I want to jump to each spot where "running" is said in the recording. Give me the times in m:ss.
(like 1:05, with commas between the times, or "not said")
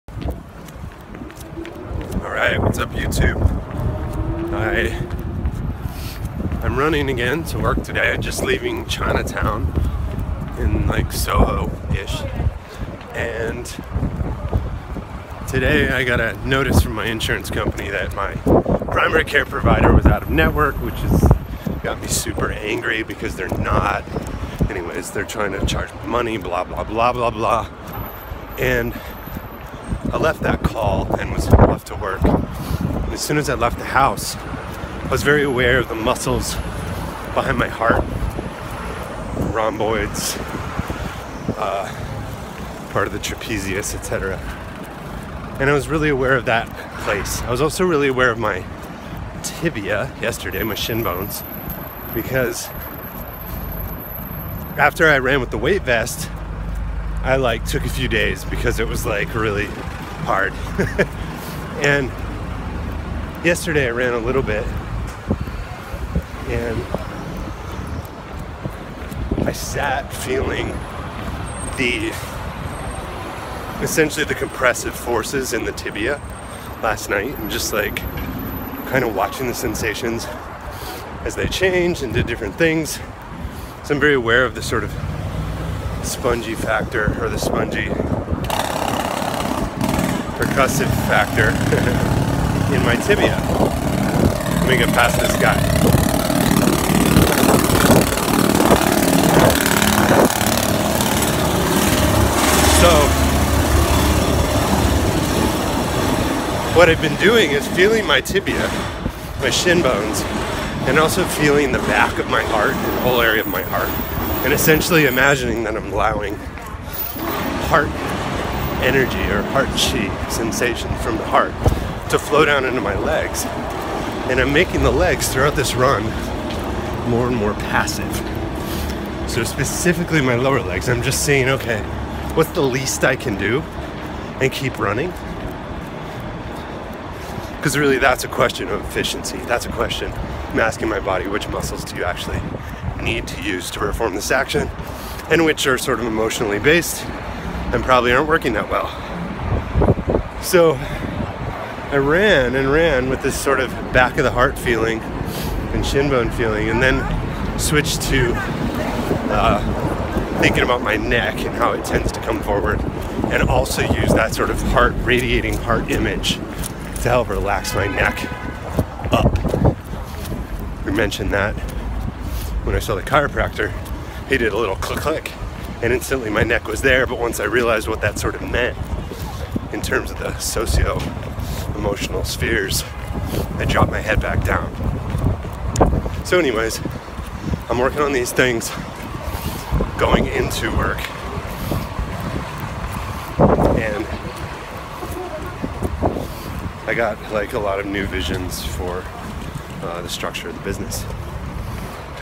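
0:06, 2:14.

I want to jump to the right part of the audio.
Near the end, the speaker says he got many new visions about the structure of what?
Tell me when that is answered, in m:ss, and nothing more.
3:20.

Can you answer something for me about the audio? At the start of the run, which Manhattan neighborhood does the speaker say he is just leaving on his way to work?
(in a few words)
Chinatown.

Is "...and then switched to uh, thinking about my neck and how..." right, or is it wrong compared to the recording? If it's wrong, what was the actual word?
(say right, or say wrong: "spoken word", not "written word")
right.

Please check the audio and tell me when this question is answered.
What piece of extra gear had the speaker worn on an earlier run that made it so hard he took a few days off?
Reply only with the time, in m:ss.
0:55.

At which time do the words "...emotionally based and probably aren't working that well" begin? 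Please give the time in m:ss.
2:26.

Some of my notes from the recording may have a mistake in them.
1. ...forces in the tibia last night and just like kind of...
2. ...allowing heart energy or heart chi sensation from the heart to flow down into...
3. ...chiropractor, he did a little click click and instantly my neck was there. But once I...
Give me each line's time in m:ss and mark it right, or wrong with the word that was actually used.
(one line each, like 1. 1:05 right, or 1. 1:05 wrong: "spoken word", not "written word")
1. 1:14 right
2. 1:55 right
3. 2:53 right.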